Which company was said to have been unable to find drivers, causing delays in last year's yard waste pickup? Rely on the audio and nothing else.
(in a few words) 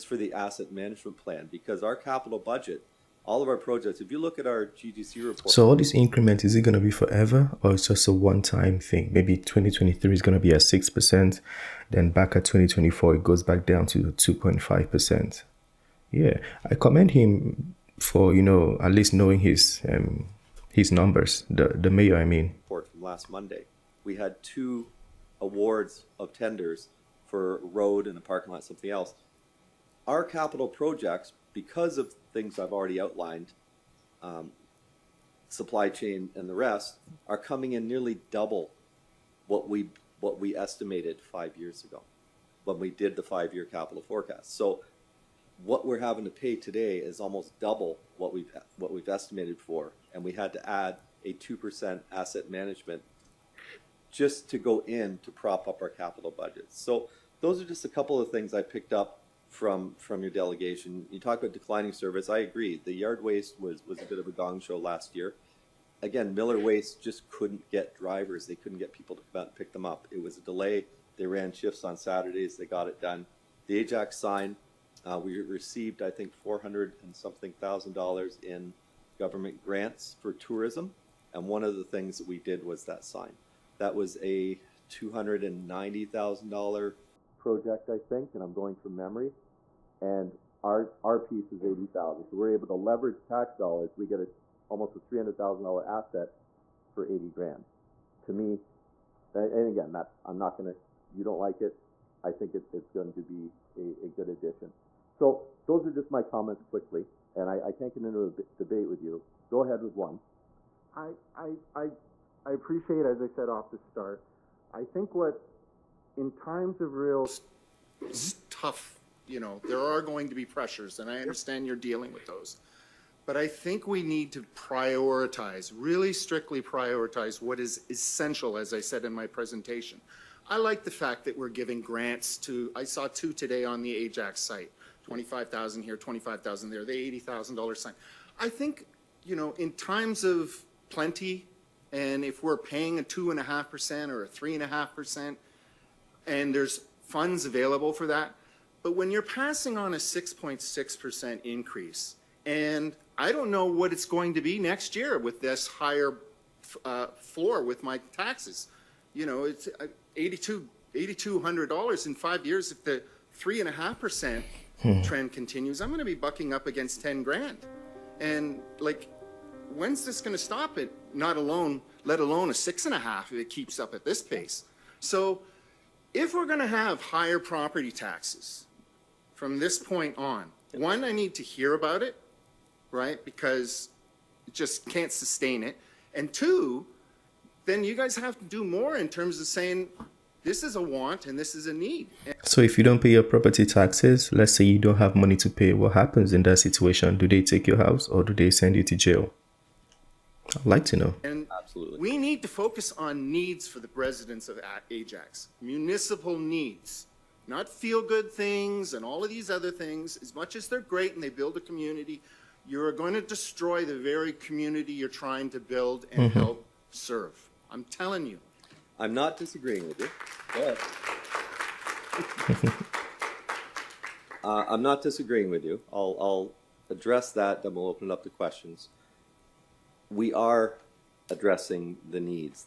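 Miller Waste.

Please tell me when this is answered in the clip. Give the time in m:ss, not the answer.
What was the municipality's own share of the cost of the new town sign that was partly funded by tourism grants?
1:31.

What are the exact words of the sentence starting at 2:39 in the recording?
You know, it's uh, 82 $8,200 in five years if the 3.5% hmm.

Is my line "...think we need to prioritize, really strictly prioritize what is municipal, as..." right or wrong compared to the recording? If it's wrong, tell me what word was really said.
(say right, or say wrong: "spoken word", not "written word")
wrong: "essential", not "municipal".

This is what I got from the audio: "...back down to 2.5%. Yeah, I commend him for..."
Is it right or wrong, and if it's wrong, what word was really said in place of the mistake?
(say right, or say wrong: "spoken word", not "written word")
right.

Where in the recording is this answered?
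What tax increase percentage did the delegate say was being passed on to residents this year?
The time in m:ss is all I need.
2:29.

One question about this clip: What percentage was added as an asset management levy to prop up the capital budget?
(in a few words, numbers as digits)
2%.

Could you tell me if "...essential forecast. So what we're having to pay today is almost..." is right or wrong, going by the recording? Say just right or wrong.
wrong.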